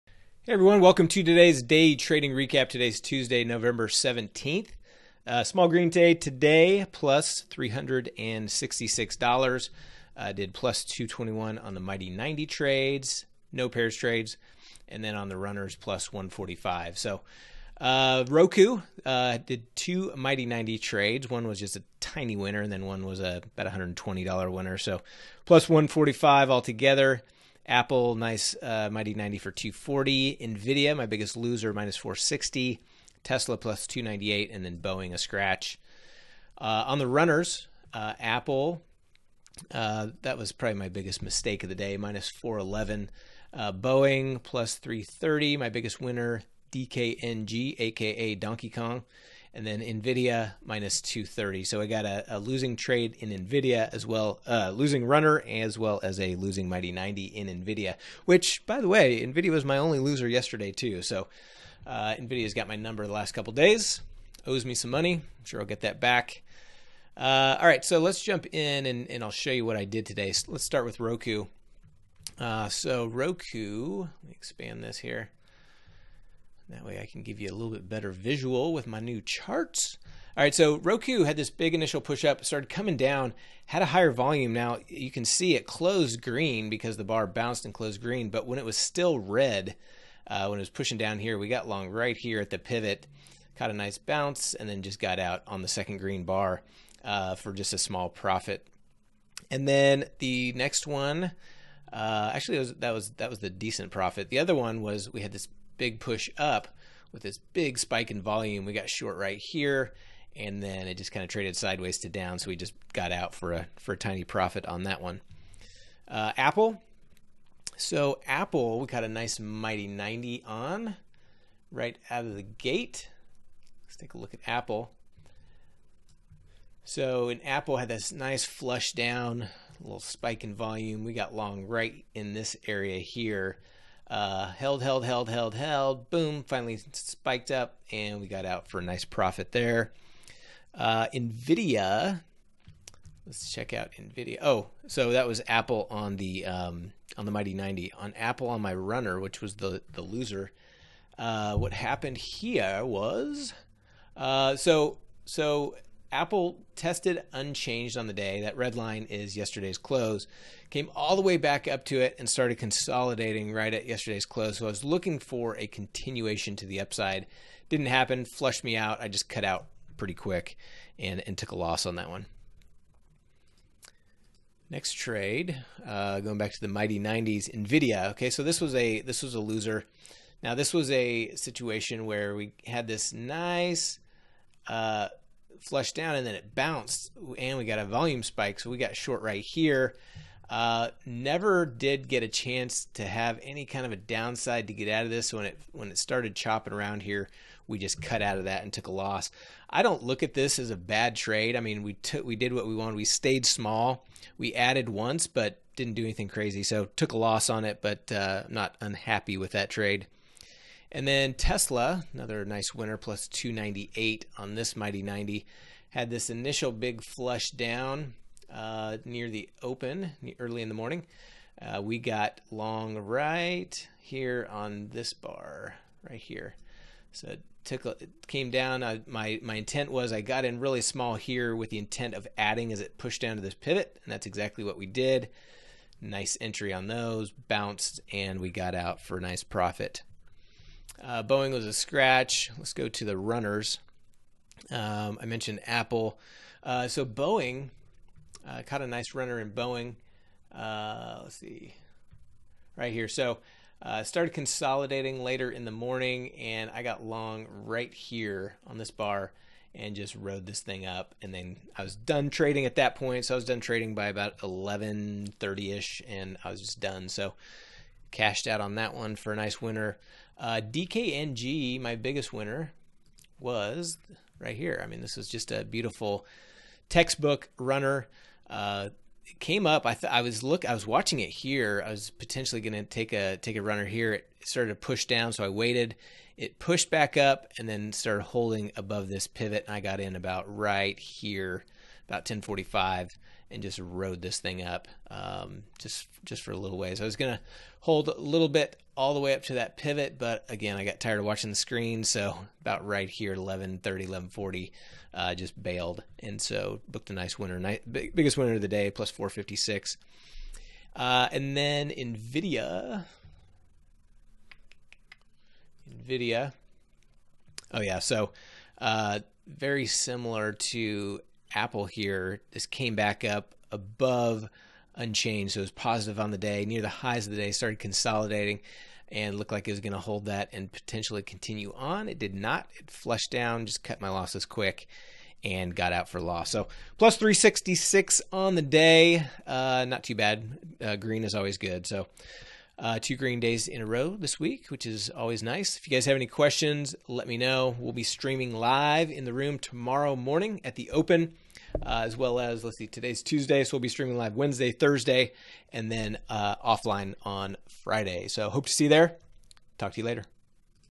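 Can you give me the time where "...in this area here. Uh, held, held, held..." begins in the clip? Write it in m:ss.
2:12.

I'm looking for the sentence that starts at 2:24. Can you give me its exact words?
Oh, so that was Apple on the um, on the Mighty 90.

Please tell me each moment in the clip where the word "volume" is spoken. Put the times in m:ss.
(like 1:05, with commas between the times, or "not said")
1:24, 1:48, 2:10, 3:07.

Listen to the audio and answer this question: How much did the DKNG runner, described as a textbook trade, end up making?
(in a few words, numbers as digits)
$456.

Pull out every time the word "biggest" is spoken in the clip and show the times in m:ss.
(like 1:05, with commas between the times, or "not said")
0:31, 0:40, 0:45, 4:31, 5:08.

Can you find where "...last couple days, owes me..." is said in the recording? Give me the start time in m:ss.
1:03.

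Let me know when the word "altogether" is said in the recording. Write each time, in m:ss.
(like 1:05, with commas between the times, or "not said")
0:26.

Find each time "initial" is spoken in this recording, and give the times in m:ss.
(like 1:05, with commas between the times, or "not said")
1:21, 3:36.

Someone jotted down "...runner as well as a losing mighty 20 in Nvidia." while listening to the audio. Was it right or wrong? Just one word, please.
wrong.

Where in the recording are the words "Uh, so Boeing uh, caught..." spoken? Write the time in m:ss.
4:06.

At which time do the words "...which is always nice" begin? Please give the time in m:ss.
5:44.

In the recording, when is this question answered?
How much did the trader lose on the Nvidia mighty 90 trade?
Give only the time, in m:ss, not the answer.
0:31.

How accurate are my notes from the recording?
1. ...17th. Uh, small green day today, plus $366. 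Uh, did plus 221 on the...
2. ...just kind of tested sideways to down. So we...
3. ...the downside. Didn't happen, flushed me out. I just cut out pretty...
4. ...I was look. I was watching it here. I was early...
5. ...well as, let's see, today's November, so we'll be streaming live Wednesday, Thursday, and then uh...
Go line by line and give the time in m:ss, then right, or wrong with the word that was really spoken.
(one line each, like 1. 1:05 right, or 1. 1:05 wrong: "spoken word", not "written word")
1. 0:03 right
2. 1:50 wrong: "traded", not "tested"
3. 2:46 wrong: "upside", not "downside"
4. 4:40 wrong: "potentially", not "early"
5. 5:52 wrong: "Tuesday", not "November".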